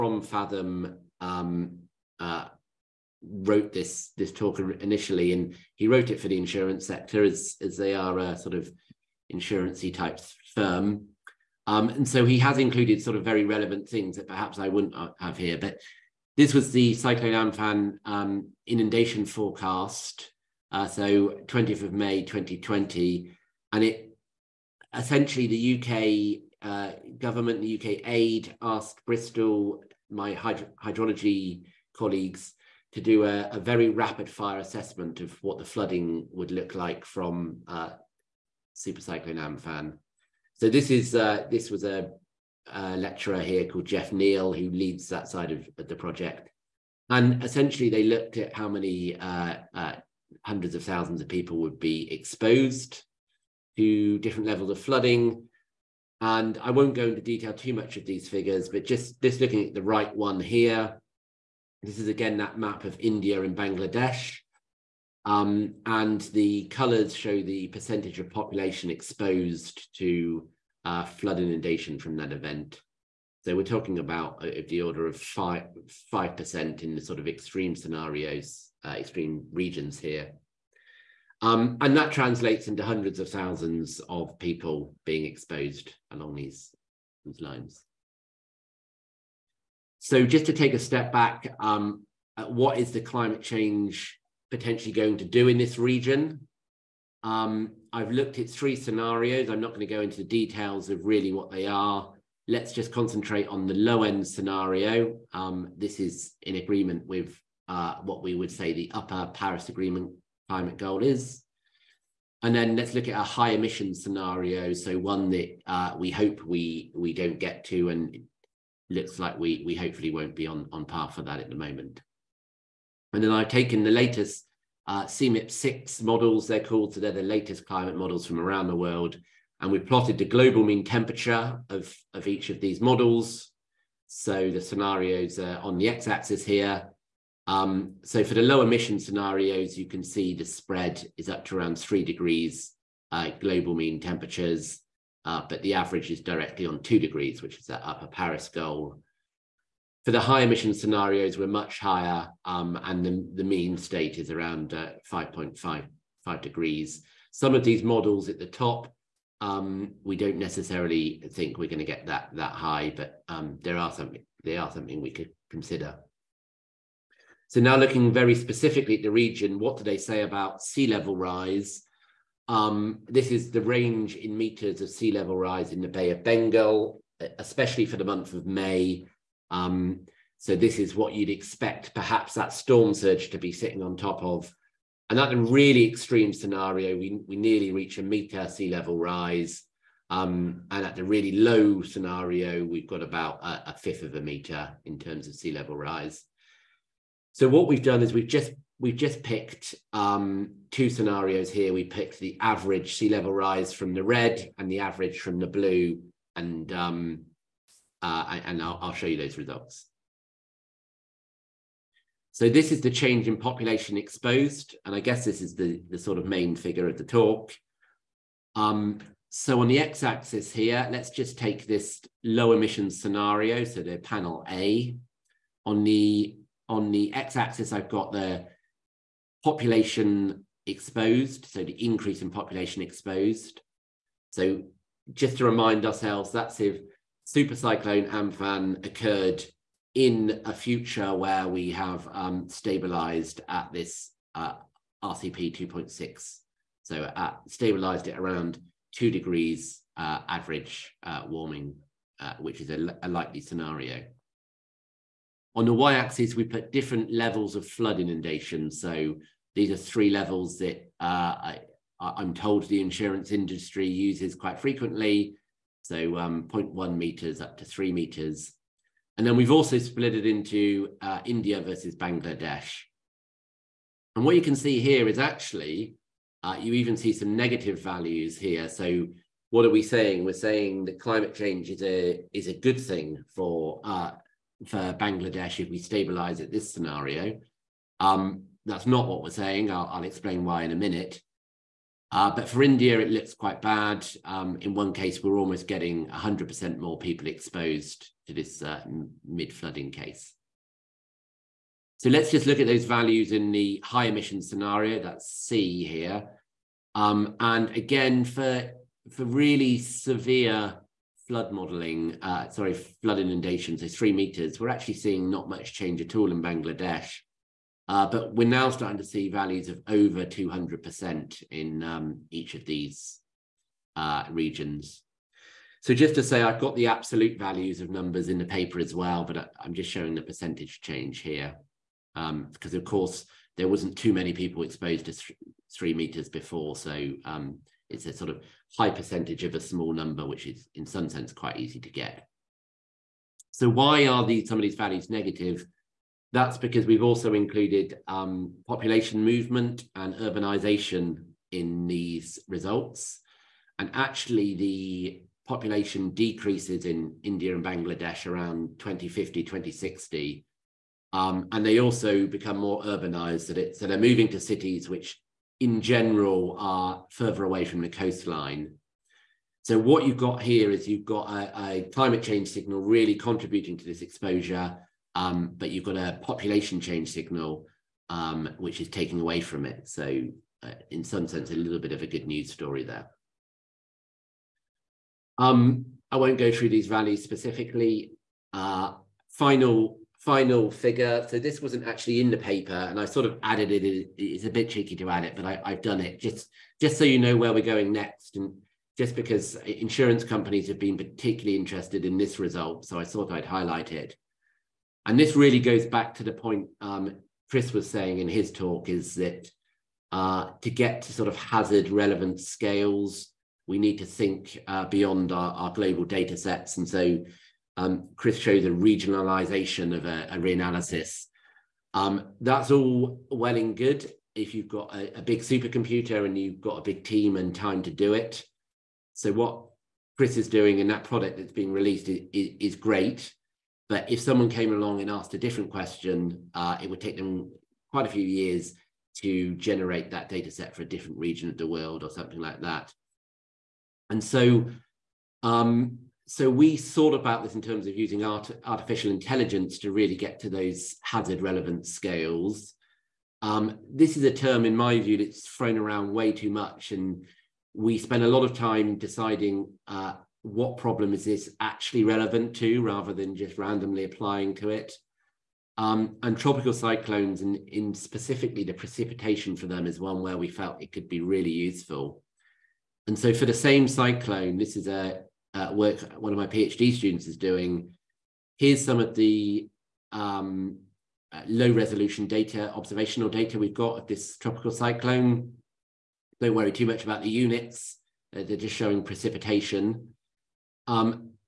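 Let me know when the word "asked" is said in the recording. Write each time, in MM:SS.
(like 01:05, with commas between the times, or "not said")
00:28, 07:15.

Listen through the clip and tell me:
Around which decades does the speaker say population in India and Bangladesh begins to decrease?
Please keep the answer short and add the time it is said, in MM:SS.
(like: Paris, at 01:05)
2050, 2060, at 05:58.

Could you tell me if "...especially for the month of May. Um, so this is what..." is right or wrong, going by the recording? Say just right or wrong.
right.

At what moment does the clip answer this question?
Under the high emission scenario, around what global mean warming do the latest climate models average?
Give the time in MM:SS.
02:35.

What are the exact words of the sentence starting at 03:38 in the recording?
Um, so on the x-axis here, let's just take this low emission scenario, so the panel A.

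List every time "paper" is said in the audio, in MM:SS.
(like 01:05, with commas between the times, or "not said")
05:28, 06:32.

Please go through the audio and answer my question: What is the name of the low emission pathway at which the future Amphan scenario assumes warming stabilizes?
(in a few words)
RCP 2.6.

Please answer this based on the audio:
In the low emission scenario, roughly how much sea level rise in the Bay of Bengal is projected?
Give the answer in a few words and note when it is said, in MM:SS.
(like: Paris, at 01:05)
a fifth of a meter, at 03:13.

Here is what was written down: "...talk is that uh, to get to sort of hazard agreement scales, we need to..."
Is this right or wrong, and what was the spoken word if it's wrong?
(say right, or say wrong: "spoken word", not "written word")
wrong: "relevant", not "agreement".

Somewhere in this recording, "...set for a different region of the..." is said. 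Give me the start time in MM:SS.
07:20.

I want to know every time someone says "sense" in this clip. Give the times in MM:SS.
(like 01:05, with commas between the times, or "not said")
05:41, 06:21.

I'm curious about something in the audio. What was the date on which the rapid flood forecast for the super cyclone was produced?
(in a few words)
20th of May 2020.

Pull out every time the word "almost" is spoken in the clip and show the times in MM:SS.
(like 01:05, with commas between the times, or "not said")
04:55.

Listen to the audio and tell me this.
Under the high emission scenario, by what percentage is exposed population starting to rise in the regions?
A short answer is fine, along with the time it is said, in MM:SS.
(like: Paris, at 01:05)
over 200%, at 05:19.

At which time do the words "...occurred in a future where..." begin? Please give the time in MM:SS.
03:58.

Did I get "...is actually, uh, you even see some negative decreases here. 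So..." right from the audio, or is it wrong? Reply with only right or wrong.
wrong.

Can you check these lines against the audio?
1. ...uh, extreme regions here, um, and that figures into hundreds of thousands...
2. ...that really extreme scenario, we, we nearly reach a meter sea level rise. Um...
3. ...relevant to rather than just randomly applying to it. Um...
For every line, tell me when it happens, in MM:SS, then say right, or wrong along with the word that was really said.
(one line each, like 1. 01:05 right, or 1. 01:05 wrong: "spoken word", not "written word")
1. 01:18 wrong: "translates", not "figures"
2. 03:05 right
3. 07:42 right.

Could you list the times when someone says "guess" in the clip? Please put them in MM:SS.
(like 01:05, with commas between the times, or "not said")
03:34.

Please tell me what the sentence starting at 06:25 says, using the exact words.
Um, I won't go through these values specifically.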